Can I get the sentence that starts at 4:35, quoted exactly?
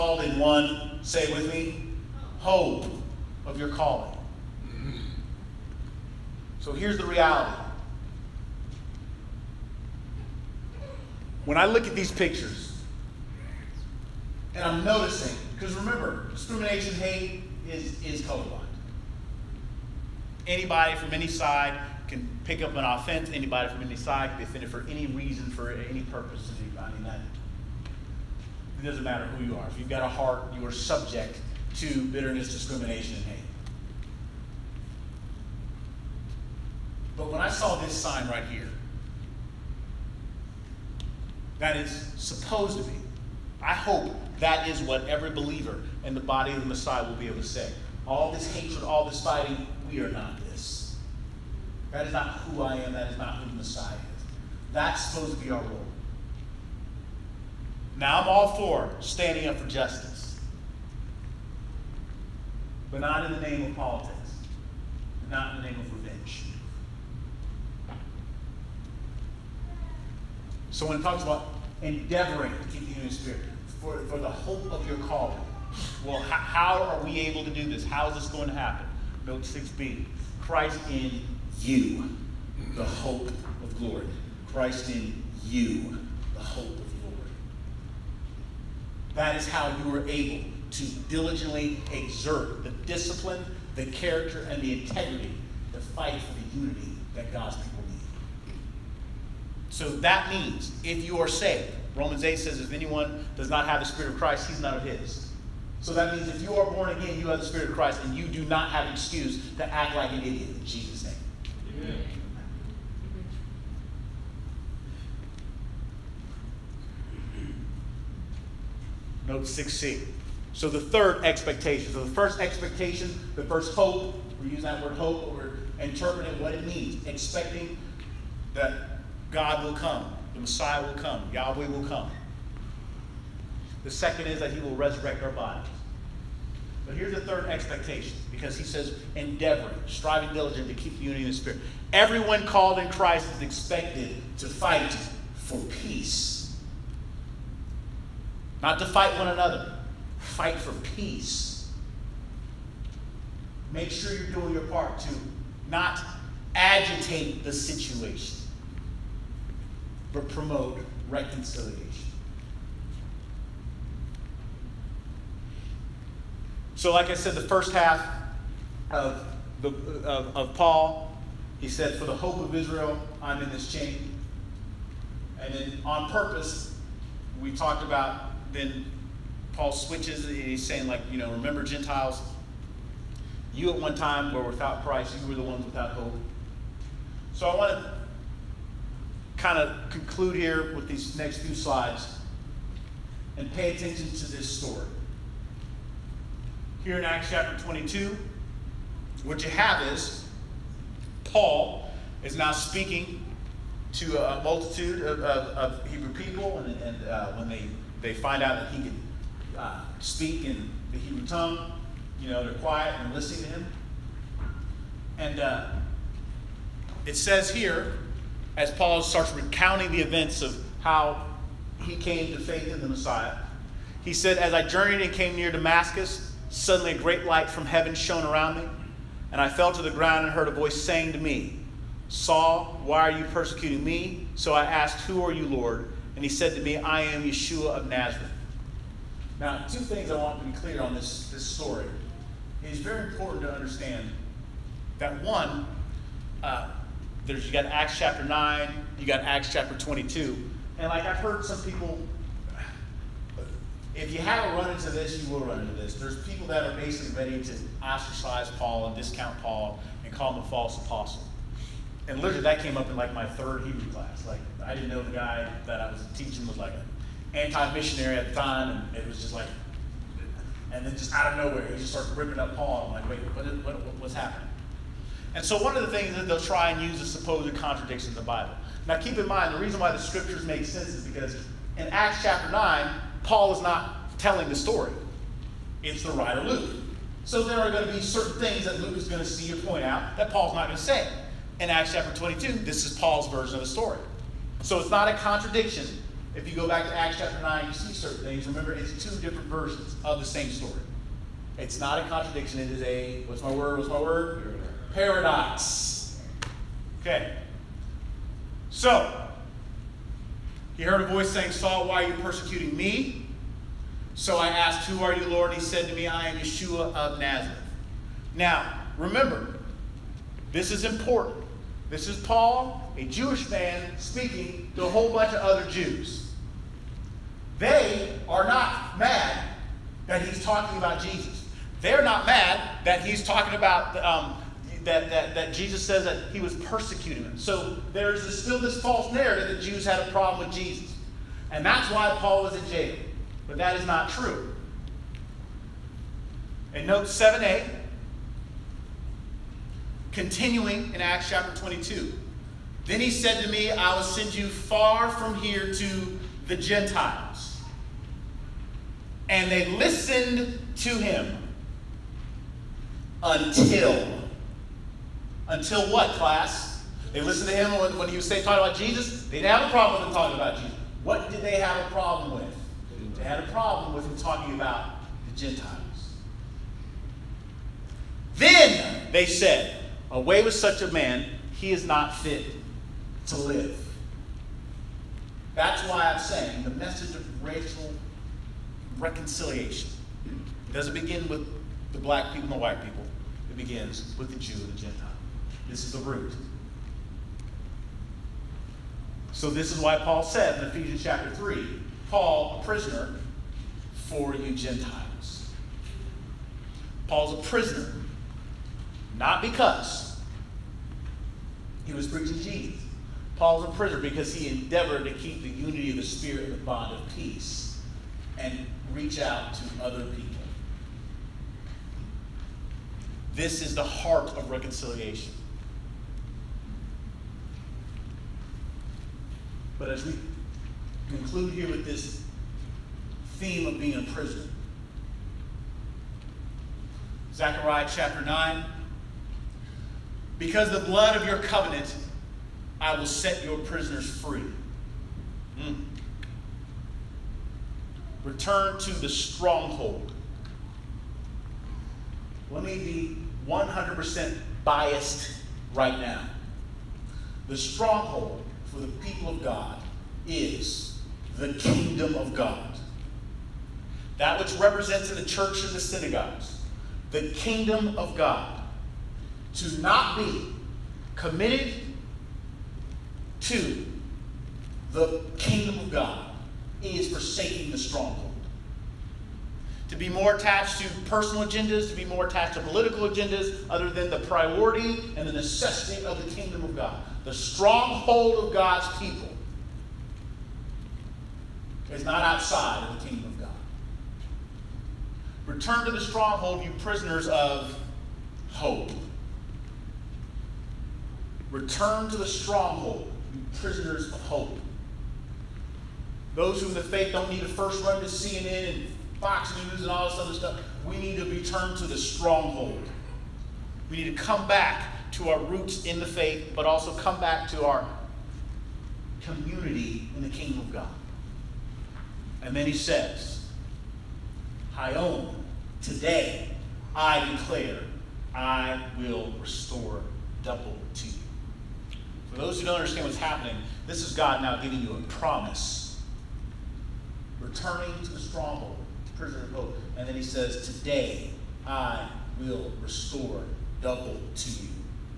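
And so one of the things that they'll try and use is supposed contradictions in the Bible.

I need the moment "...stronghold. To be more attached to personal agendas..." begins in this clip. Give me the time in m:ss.
7:57.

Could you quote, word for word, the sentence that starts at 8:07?
The stronghold of God's people is not outside of the kingdom of God.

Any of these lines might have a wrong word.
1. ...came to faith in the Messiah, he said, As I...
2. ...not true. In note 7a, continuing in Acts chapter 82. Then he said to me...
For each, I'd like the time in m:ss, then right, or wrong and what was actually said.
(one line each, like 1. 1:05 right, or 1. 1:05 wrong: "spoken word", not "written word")
1. 3:41 right
2. 5:43 wrong: "22", not "82".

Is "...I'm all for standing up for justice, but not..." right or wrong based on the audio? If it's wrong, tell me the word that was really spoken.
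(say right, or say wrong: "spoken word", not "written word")
right.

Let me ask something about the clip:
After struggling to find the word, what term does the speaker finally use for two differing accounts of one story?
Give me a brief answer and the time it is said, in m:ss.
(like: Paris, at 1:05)
Paradox, at 5:04.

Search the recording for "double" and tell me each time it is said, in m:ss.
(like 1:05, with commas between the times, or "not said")
8:50, 9:03.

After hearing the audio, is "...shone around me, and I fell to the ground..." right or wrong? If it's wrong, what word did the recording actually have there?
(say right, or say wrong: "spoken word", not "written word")
right.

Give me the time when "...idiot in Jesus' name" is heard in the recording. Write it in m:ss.
1:50.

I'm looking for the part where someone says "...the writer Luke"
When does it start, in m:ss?
4:46.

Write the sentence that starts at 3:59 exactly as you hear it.
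Now, two things I want to be clear on this, this story.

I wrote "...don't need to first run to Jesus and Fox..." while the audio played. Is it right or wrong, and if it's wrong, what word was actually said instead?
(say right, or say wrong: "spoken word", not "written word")
wrong: "CNN", not "Jesus".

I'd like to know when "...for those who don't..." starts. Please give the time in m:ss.
8:52.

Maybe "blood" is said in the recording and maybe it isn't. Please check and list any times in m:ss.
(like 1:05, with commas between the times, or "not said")
7:20.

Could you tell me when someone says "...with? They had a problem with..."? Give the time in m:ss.
6:12.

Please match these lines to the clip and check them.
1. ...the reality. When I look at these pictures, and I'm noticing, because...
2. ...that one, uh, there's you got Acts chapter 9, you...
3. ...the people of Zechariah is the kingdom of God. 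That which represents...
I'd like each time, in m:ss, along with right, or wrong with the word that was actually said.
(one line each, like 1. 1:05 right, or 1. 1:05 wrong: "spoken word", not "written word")
1. 0:06 right
2. 4:04 right
3. 7:38 wrong: "God", not "Zechariah".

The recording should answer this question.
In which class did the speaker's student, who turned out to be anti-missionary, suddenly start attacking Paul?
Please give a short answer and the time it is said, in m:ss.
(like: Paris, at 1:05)
third Hebrew class, at 4:23.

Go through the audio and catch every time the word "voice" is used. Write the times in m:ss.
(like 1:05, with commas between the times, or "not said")
3:50, 5:11.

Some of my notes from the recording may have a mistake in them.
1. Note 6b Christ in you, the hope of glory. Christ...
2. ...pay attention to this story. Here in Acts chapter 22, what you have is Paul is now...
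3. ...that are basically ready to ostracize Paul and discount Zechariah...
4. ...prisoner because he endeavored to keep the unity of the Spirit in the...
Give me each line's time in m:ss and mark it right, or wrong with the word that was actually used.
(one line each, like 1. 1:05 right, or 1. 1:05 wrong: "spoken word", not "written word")
1. 1:19 right
2. 3:13 right
3. 4:16 wrong: "Paul", not "Zechariah"
4. 6:53 right.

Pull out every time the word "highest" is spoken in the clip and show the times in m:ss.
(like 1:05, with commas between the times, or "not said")
not said.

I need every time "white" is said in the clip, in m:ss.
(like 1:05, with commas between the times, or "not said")
6:32.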